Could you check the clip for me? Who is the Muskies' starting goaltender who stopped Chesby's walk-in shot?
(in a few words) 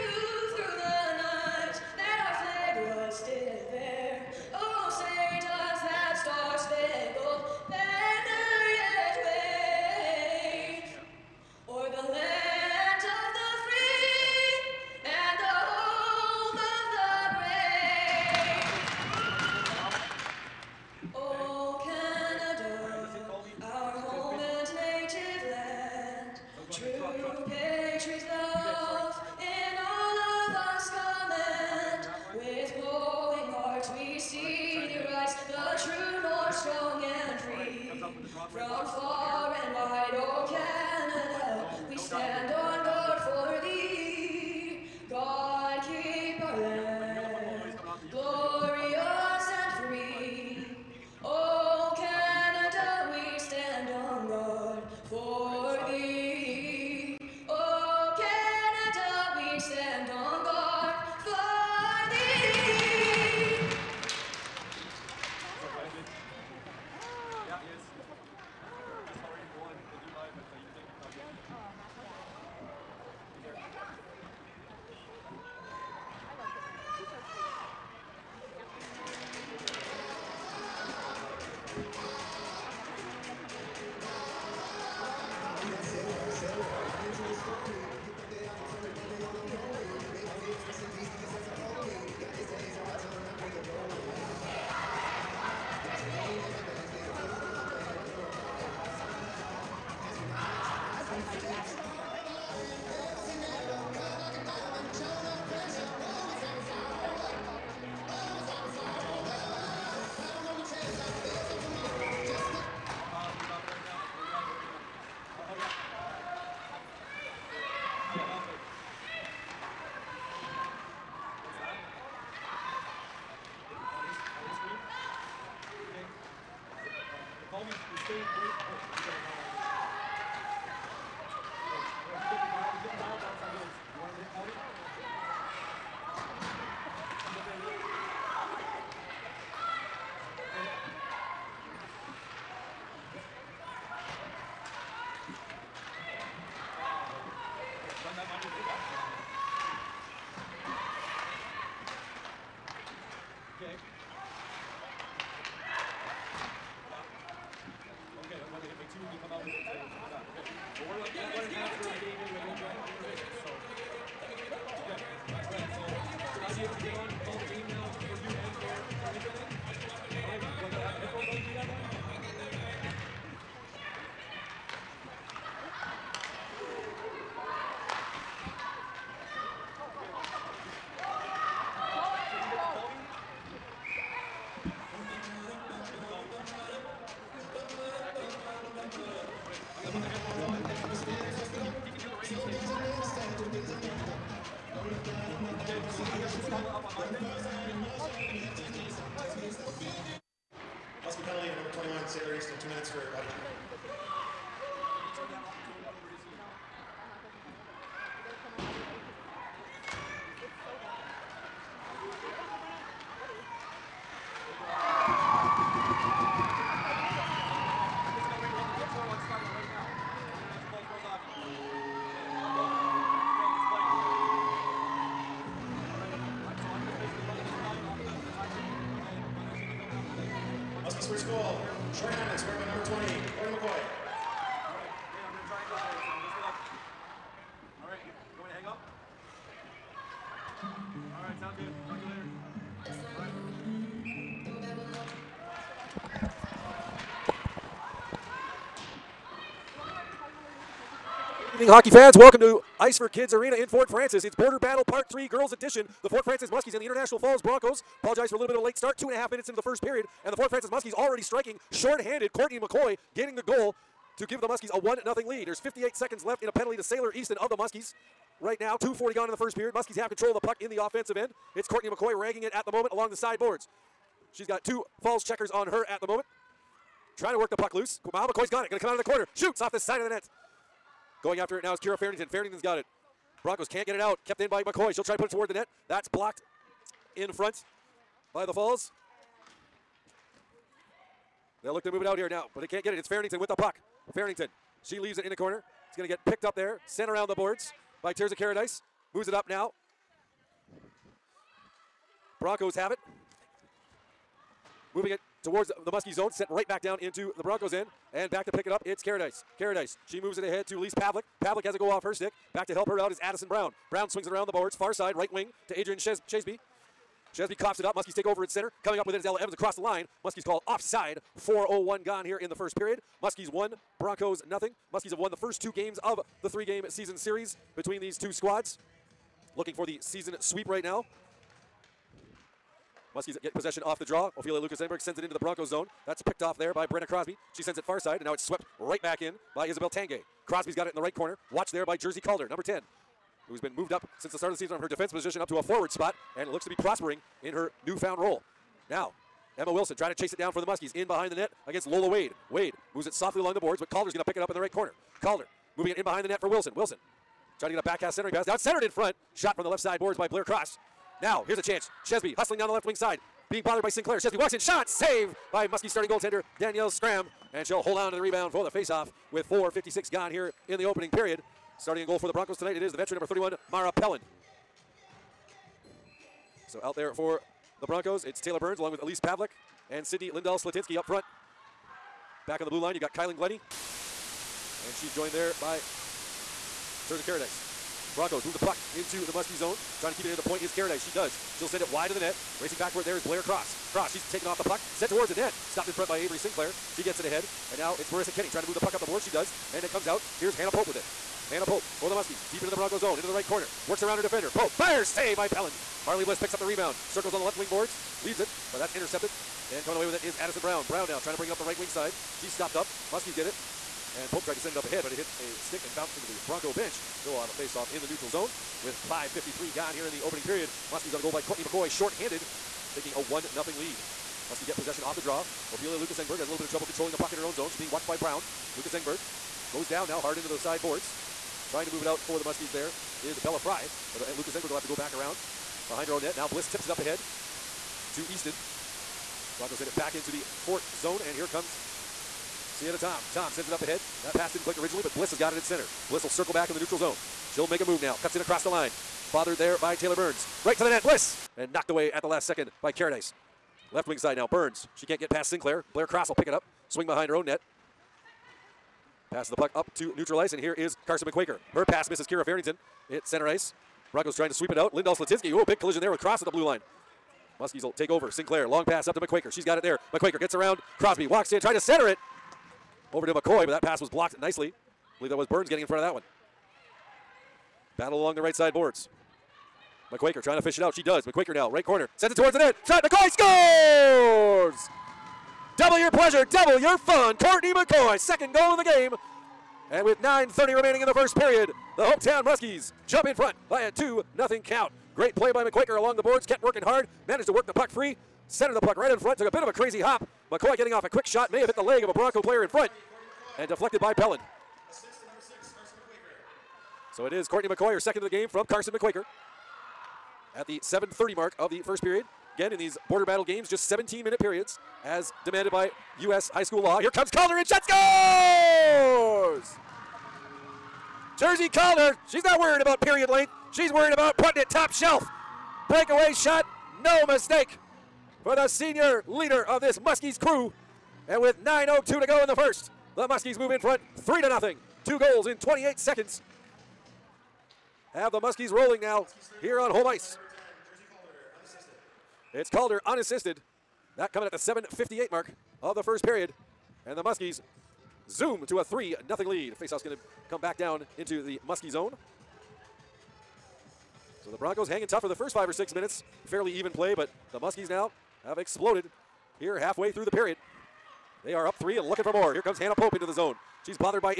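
Danielle Scram.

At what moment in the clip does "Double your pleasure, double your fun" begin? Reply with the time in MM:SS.
08:05.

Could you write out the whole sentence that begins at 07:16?
Now Bliss tips it up ahead to Easton.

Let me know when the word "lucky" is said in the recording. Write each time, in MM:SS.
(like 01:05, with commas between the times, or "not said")
not said.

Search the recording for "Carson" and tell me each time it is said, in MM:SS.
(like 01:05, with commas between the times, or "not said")
07:41, 08:28.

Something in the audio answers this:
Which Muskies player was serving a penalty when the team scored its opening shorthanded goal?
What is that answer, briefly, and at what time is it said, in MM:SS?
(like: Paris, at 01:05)
Sailor Easton, at 04:26.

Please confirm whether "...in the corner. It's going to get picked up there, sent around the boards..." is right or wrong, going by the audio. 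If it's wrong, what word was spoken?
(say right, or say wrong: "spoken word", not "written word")
right.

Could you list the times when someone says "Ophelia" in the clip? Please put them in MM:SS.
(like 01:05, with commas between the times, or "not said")
05:34, 07:05.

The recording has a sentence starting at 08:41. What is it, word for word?
Jersey Calder, she's not worried about period length.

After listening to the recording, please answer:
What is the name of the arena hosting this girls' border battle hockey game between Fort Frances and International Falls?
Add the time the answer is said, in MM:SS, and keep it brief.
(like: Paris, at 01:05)
Ice for Kids Arena, at 04:12.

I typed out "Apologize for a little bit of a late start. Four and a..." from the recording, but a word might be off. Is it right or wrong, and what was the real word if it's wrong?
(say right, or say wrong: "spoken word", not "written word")
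wrong: "Two", not "Four".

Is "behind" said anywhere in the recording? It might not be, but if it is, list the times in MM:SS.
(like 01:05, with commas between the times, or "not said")
05:51, 05:56, 07:15, 07:37.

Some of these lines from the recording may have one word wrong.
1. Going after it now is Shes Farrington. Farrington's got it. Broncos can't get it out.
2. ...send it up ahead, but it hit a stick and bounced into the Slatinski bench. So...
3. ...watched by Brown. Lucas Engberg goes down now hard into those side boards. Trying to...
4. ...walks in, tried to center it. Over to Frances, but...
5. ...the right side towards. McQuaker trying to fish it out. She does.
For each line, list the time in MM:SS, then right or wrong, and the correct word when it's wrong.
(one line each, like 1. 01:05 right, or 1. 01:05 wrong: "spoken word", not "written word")
1. 04:41 wrong: "Kira", not "Shes"
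2. 06:54 wrong: "Bronco", not "Slatinski"
3. 07:07 right
4. 07:51 wrong: "McCoy", not "Frances"
5. 07:58 wrong: "boards", not "towards".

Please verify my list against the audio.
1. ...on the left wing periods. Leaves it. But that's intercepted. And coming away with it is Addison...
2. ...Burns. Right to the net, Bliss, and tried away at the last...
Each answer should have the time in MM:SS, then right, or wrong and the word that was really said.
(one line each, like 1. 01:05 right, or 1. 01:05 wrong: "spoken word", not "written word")
1. 06:47 wrong: "boards", not "periods"
2. 07:30 wrong: "knocked", not "tried".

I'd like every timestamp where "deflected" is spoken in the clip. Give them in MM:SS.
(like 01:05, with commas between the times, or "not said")
08:23.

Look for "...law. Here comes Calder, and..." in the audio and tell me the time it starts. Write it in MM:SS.
08:36.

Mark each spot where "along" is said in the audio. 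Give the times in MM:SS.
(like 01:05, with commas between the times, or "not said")
04:32, 05:53, 06:18, 07:58, 08:15.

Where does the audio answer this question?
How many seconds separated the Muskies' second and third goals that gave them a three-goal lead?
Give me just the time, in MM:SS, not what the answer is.
08:55.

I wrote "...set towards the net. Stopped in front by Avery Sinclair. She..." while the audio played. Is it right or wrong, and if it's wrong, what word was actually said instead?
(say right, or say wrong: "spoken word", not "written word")
right.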